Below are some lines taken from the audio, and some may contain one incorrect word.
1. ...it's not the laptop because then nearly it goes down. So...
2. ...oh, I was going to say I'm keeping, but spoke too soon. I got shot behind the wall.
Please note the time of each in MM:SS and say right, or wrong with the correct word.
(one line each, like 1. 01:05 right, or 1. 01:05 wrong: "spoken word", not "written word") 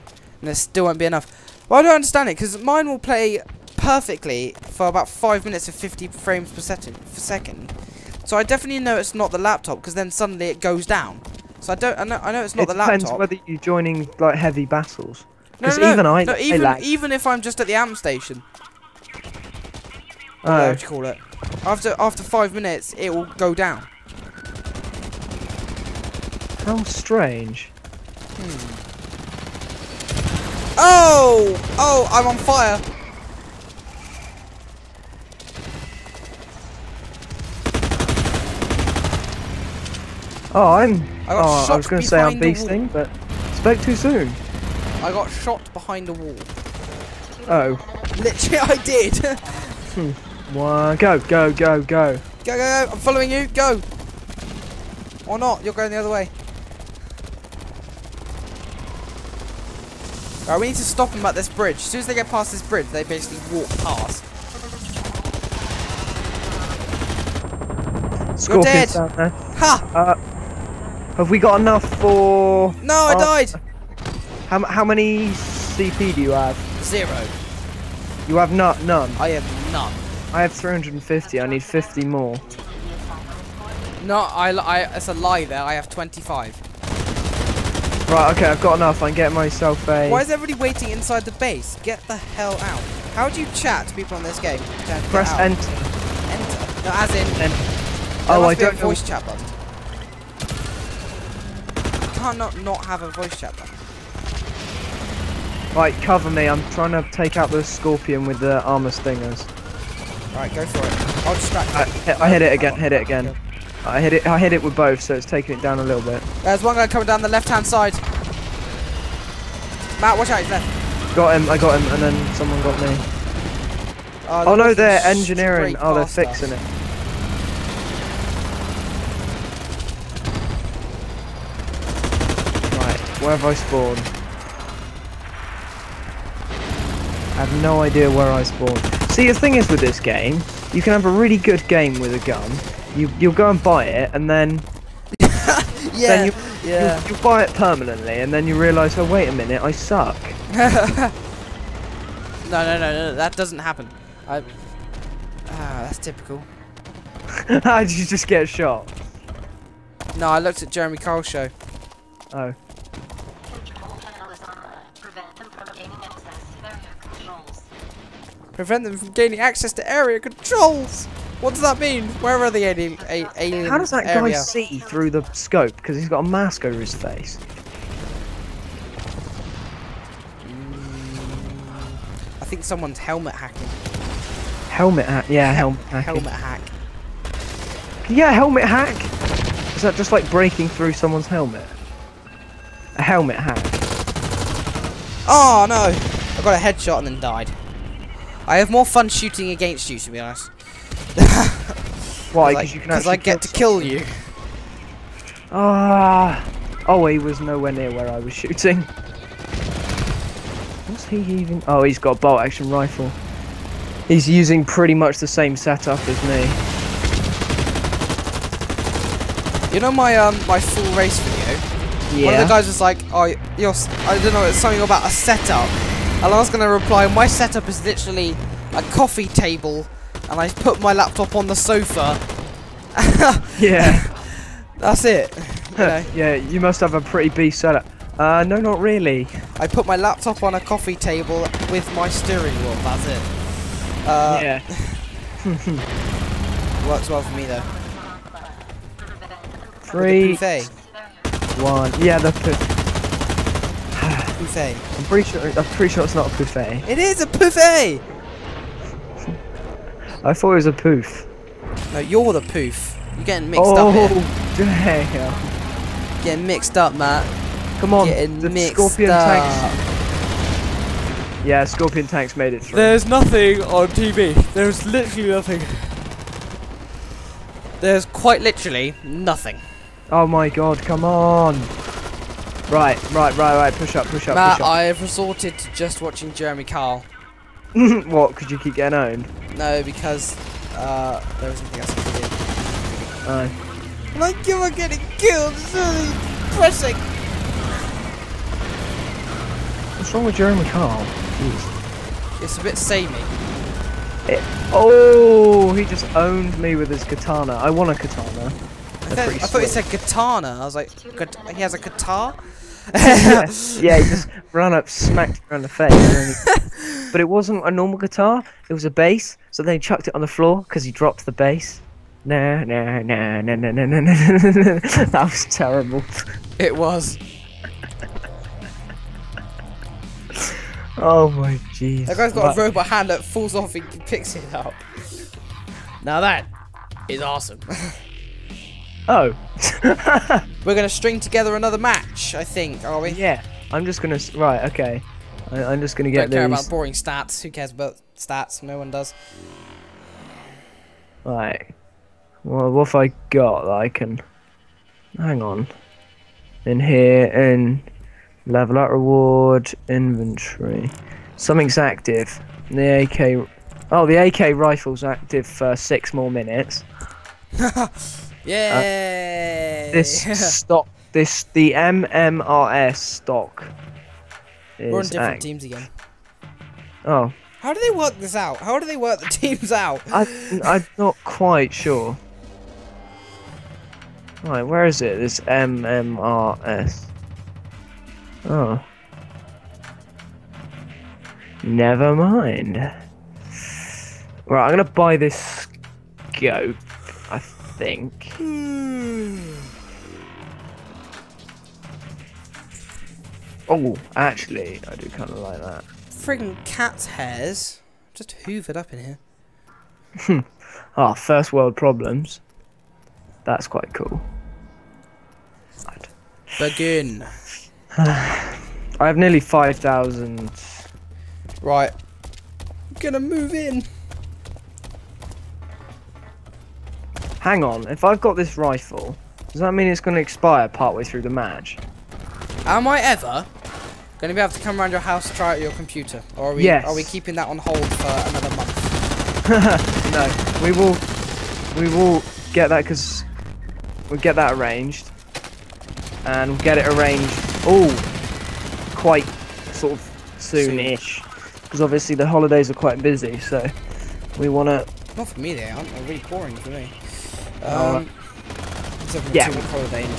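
1. 00:08 wrong: "suddenly", not "nearly"
2. 00:41 wrong: "beasting", not "keeping".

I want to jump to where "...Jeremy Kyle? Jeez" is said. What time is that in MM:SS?
05:00.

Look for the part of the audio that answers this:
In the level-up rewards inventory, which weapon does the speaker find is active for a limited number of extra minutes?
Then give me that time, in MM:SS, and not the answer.
06:04.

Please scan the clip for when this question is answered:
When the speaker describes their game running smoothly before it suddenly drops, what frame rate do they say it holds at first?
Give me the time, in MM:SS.
00:05.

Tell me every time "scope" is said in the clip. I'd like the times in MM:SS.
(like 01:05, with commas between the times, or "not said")
02:55, 06:36.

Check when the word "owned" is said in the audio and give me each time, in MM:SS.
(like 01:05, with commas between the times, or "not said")
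04:48, 05:06.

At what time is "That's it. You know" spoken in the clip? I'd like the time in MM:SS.
03:54.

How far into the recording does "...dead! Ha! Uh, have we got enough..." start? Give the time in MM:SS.
01:09.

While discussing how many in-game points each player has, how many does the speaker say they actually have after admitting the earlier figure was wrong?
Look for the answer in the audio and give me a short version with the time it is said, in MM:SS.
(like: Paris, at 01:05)
25, at 01:25.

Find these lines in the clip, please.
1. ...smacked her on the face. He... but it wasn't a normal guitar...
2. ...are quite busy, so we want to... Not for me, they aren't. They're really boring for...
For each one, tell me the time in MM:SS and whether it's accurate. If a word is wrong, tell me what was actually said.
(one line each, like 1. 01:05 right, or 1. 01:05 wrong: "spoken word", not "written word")
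1. 05:14 right
2. 07:32 right.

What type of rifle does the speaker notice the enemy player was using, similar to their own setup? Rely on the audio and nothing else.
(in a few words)
Bolt action rifle.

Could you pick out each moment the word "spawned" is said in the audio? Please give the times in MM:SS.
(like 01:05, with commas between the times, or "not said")
02:13, 02:18.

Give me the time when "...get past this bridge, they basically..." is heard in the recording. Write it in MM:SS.
01:02.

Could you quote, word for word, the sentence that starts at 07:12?
Am I ever going to be able to come around your house try out your computer?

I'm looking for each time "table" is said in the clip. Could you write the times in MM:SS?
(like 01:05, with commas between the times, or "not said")
03:49, 04:00.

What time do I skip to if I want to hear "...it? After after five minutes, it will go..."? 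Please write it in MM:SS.
00:21.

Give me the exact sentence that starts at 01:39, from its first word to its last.
chat button not have a voice chat then.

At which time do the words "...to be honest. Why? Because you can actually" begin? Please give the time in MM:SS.
03:19.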